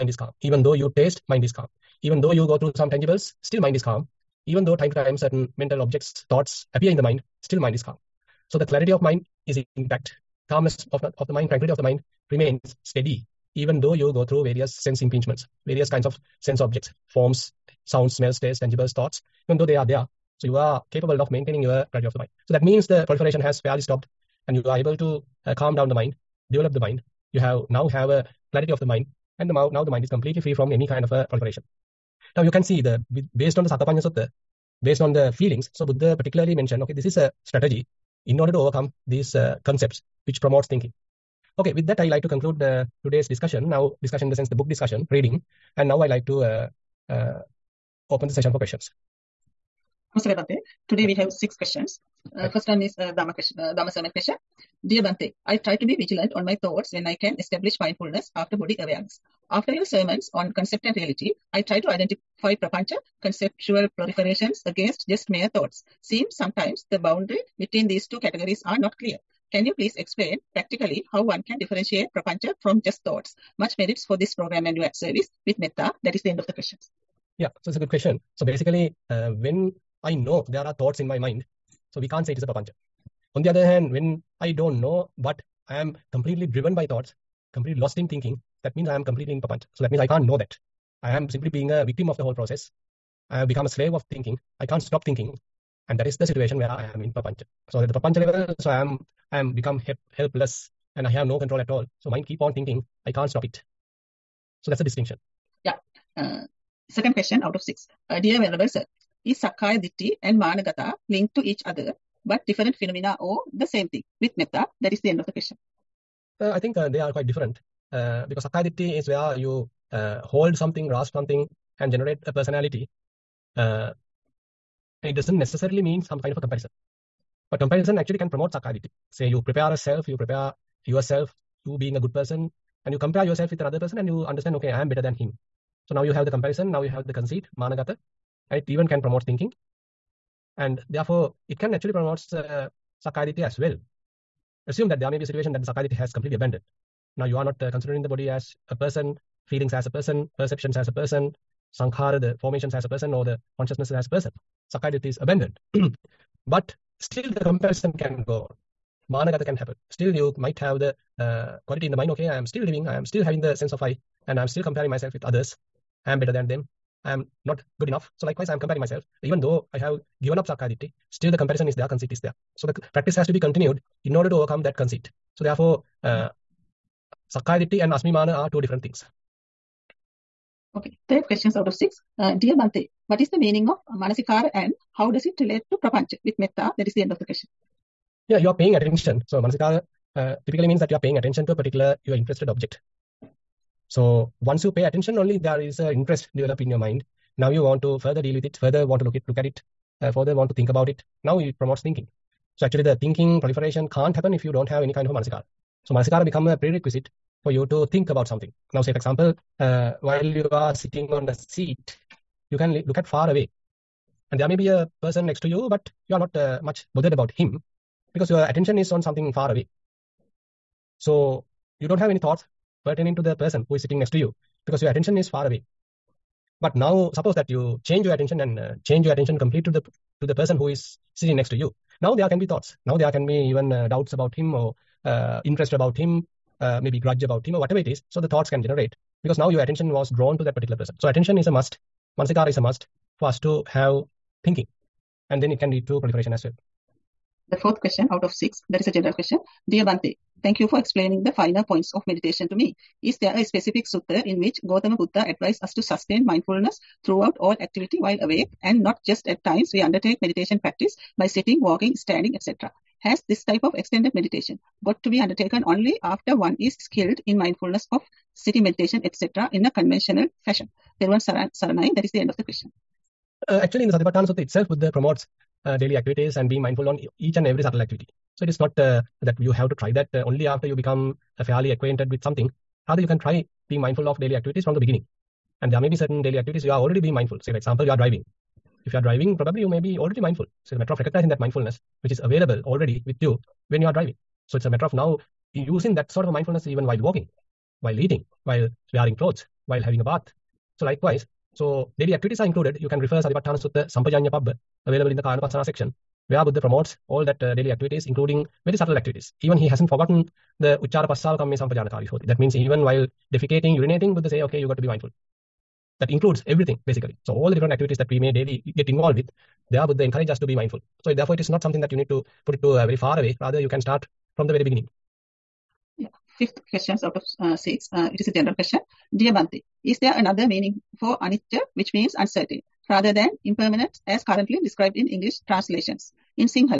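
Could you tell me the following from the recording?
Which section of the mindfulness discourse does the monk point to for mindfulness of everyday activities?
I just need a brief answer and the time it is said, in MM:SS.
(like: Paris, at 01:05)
Sampajanya Pabba, at 05:03.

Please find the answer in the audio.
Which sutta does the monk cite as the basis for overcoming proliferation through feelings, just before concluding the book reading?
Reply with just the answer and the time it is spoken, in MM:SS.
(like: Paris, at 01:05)
Sakkapanha Sutta, at 00:33.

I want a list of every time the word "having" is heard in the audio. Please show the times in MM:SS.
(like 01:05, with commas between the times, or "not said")
02:43, 04:59.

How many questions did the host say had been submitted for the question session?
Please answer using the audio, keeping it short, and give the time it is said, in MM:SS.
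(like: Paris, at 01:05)
6, at 00:51.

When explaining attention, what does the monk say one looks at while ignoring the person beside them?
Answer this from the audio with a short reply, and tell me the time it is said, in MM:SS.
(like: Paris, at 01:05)
something far away, at 03:39.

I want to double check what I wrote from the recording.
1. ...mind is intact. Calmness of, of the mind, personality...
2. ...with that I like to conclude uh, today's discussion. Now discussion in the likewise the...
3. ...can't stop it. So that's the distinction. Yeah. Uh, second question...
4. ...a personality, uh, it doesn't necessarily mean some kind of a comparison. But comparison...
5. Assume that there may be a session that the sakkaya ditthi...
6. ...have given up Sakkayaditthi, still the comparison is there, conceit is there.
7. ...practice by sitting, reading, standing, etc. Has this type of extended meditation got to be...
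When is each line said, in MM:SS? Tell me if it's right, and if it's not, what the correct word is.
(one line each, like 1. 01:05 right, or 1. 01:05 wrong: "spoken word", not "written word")
1. 00:09 wrong: "tranquility", not "personality"
2. 00:41 wrong: "sense", not "likewise"
3. 01:43 right
4. 02:02 right
5. 02:24 wrong: "situation", not "session"
6. 02:49 right
7. 04:20 wrong: "walking", not "reading".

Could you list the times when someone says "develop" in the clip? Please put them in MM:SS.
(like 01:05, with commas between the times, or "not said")
00:26, 03:16.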